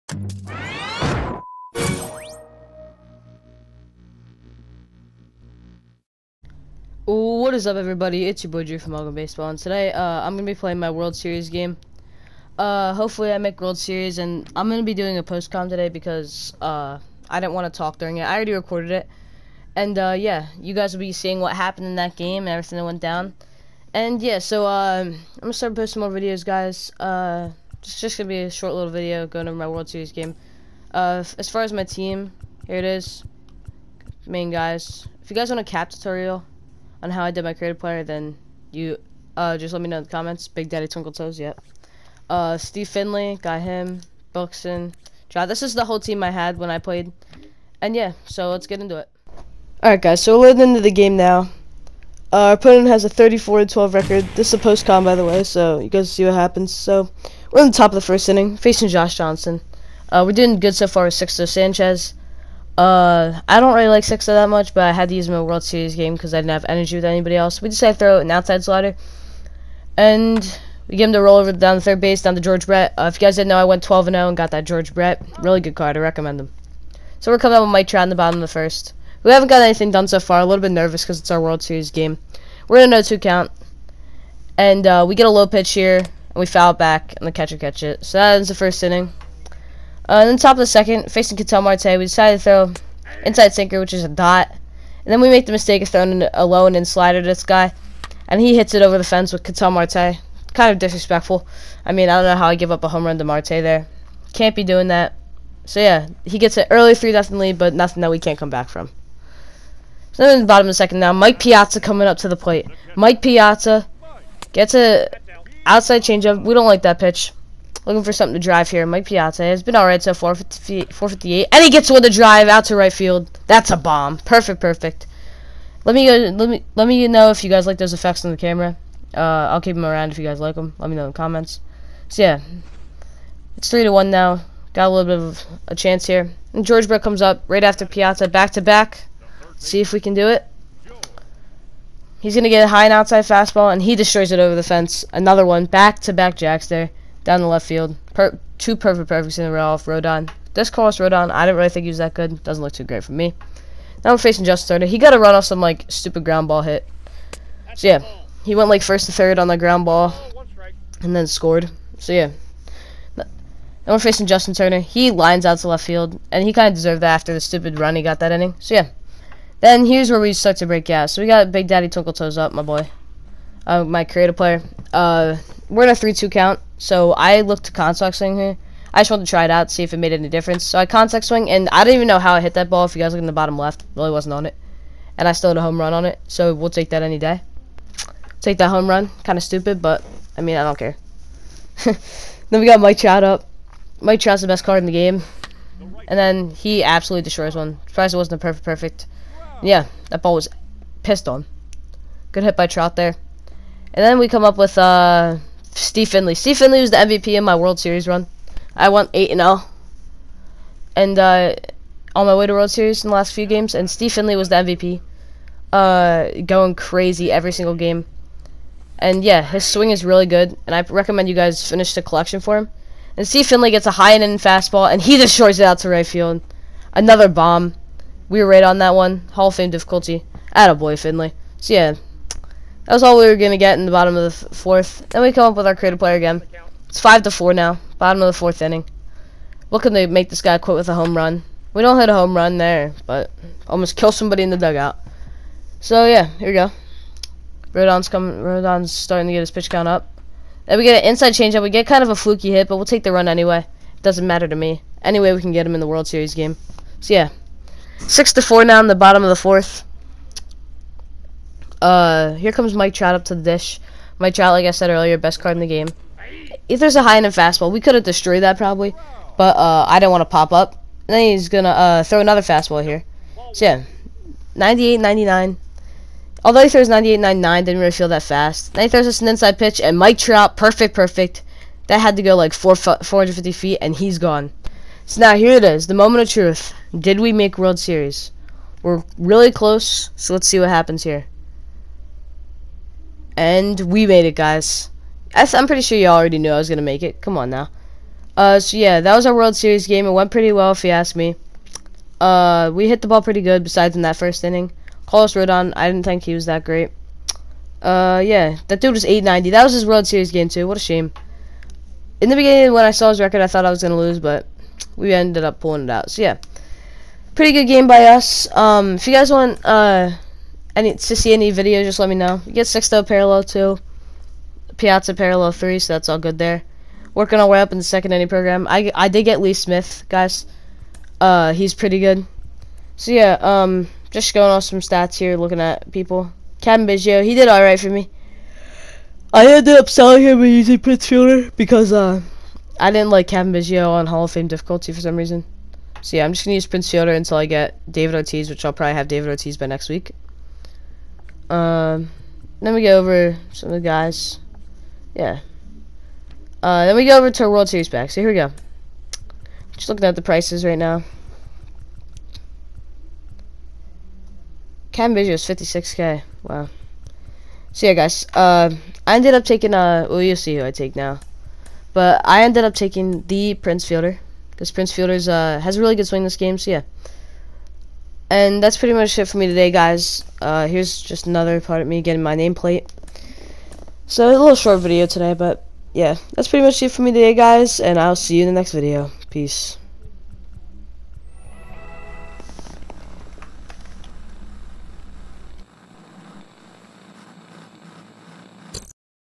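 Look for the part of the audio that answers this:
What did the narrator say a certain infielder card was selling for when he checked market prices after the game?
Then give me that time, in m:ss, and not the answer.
6:05.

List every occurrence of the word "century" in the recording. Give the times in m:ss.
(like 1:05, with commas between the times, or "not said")
not said.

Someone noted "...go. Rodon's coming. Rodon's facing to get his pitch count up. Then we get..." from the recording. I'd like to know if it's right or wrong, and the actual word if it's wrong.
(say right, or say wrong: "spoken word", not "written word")
wrong: "starting", not "facing".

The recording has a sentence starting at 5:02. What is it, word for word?
Uh, we hit the ball pretty good, besides in that first inning.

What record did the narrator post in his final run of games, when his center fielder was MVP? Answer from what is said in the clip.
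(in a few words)
8-0.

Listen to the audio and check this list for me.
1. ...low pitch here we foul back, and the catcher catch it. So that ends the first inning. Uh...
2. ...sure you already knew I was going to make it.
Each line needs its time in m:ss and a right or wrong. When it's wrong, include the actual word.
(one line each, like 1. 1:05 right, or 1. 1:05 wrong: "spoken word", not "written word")
1. 1:25 right
2. 4:55 right.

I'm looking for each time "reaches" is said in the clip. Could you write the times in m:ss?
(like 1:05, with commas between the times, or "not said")
not said.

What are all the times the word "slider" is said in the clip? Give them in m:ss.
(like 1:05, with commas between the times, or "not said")
1:08, 1:36.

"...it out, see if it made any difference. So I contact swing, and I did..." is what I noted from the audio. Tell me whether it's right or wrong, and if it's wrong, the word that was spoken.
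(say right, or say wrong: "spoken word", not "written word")
right.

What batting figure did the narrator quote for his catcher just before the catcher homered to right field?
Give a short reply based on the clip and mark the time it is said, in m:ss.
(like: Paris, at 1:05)
458, at 2:00.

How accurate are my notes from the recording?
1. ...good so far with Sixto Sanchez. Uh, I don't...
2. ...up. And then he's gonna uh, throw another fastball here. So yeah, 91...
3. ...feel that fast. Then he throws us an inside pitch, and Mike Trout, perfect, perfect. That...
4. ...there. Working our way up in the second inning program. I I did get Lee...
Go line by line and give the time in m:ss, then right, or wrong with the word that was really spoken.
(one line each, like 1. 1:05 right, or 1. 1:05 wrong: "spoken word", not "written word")
1. 1:00 right
2. 4:30 wrong: "98", not "91"
3. 4:37 right
4. 5:26 right.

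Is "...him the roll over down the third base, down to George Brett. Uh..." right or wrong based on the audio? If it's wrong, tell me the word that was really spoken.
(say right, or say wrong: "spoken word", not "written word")
right.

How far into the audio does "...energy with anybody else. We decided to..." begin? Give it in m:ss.
1:06.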